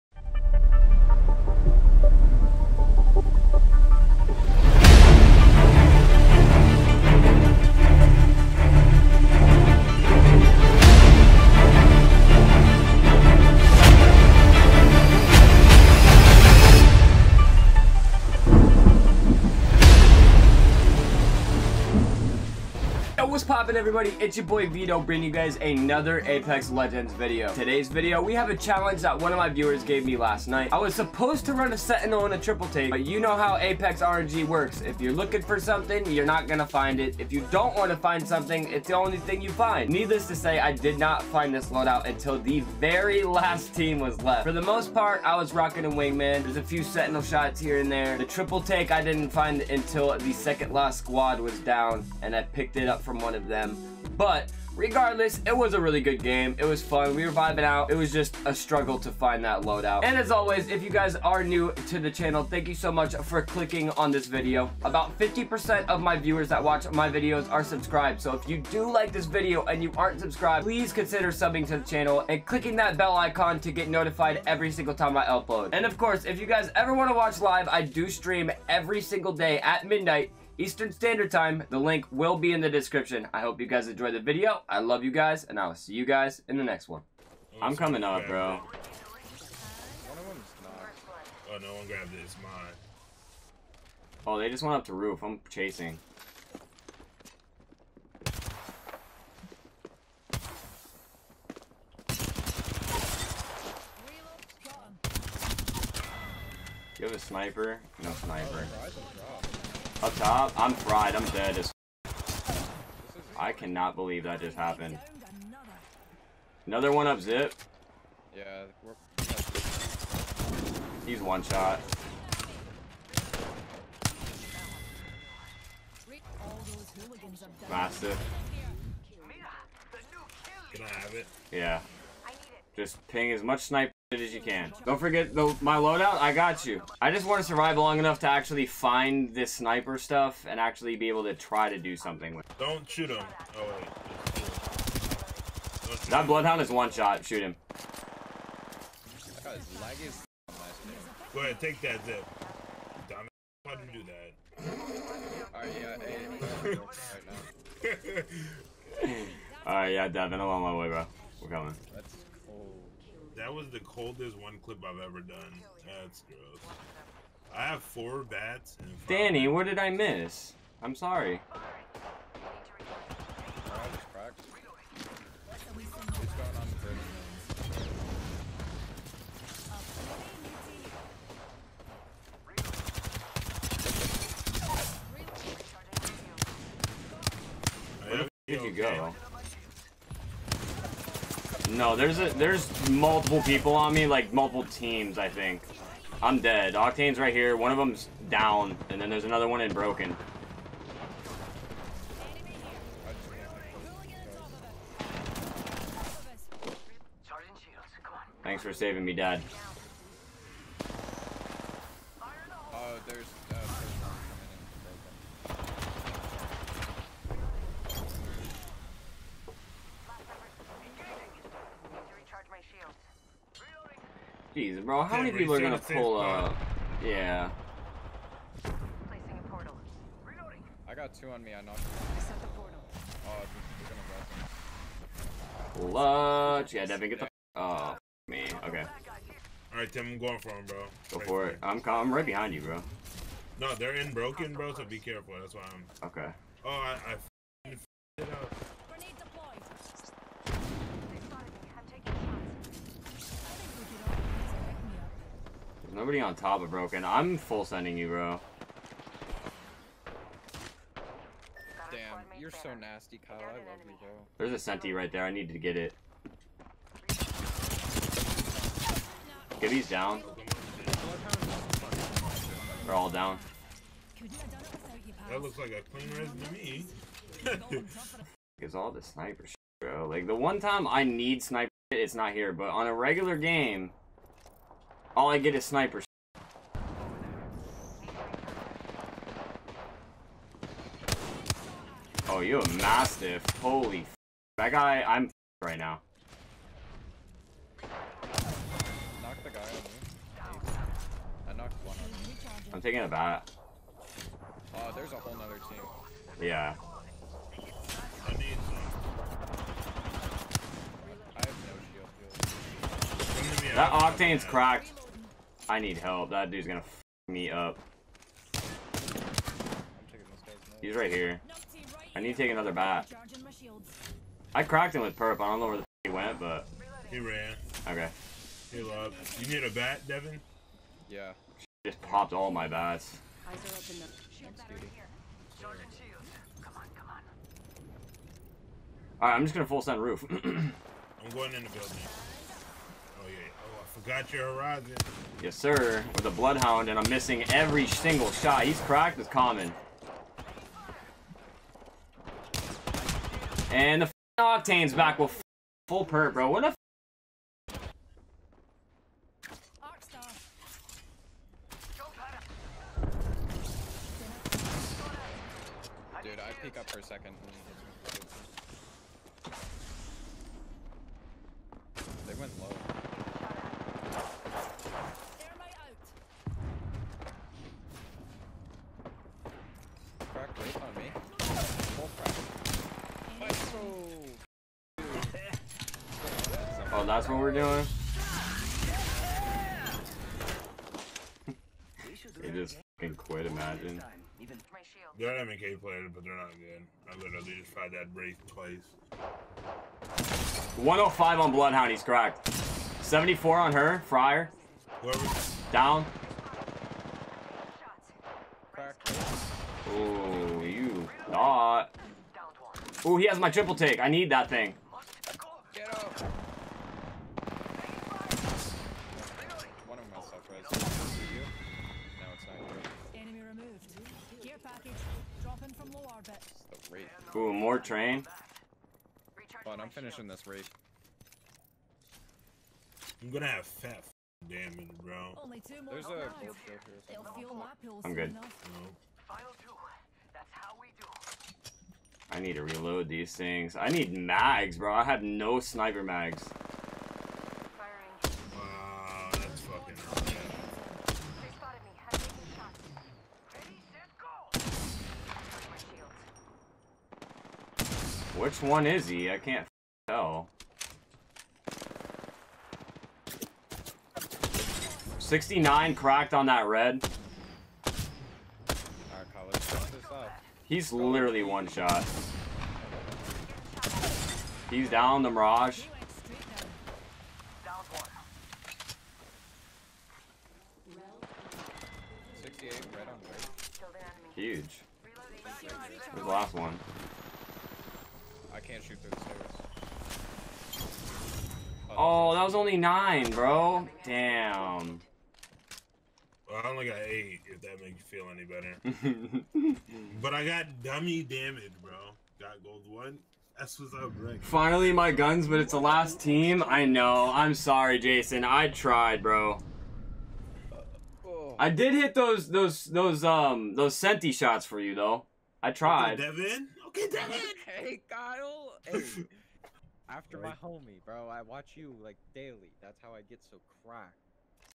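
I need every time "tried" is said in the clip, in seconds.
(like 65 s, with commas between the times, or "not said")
397 s, 508 s, 515 s.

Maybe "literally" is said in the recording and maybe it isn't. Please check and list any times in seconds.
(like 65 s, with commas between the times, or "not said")
397 s, 470 s.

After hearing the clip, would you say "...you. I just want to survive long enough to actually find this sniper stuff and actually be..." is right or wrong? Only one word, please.
right.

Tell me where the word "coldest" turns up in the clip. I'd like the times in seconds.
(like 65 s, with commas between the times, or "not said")
163 s.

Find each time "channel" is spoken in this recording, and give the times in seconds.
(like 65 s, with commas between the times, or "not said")
62 s, 71 s.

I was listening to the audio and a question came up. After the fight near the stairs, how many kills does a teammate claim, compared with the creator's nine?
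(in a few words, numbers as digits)
8.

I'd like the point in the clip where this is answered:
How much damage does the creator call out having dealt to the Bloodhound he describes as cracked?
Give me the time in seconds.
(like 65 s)
400 s.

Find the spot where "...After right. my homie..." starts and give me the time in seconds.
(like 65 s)
520 s.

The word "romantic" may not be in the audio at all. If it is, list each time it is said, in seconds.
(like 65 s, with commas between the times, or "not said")
not said.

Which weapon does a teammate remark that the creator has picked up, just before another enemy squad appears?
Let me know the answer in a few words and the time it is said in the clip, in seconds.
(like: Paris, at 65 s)
Mastiff, at 292 s.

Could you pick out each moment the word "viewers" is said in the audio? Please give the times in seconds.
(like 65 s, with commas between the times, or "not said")
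29 s, 66 s.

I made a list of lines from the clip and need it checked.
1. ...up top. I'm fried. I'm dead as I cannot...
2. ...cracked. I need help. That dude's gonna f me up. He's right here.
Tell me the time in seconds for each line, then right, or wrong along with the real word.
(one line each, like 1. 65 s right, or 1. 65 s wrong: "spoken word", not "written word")
1. 110 s right
2. 314 s right.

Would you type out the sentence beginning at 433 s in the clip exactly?
I'm gonna have fat damage, bro.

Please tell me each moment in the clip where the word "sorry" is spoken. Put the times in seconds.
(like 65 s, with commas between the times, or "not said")
170 s, 507 s.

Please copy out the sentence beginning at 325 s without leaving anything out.
I don't know where the f he went, but...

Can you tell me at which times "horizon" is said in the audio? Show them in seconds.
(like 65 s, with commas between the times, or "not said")
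344 s.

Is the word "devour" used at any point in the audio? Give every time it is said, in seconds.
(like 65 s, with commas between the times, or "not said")
not said.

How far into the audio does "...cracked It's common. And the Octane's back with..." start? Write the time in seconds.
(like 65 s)
348 s.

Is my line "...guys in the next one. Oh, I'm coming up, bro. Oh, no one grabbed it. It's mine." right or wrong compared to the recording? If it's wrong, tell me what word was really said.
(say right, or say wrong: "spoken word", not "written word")
right.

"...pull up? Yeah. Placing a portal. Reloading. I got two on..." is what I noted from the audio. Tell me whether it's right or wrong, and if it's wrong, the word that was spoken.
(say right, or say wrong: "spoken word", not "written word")
right.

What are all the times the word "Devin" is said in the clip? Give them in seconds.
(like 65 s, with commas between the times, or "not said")
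160 s, 236 s, 330 s, 516 s.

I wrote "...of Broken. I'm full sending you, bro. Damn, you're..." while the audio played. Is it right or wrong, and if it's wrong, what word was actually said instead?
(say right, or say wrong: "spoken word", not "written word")
right.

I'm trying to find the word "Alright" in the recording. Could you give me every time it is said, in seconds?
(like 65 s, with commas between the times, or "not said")
159 s, 339 s.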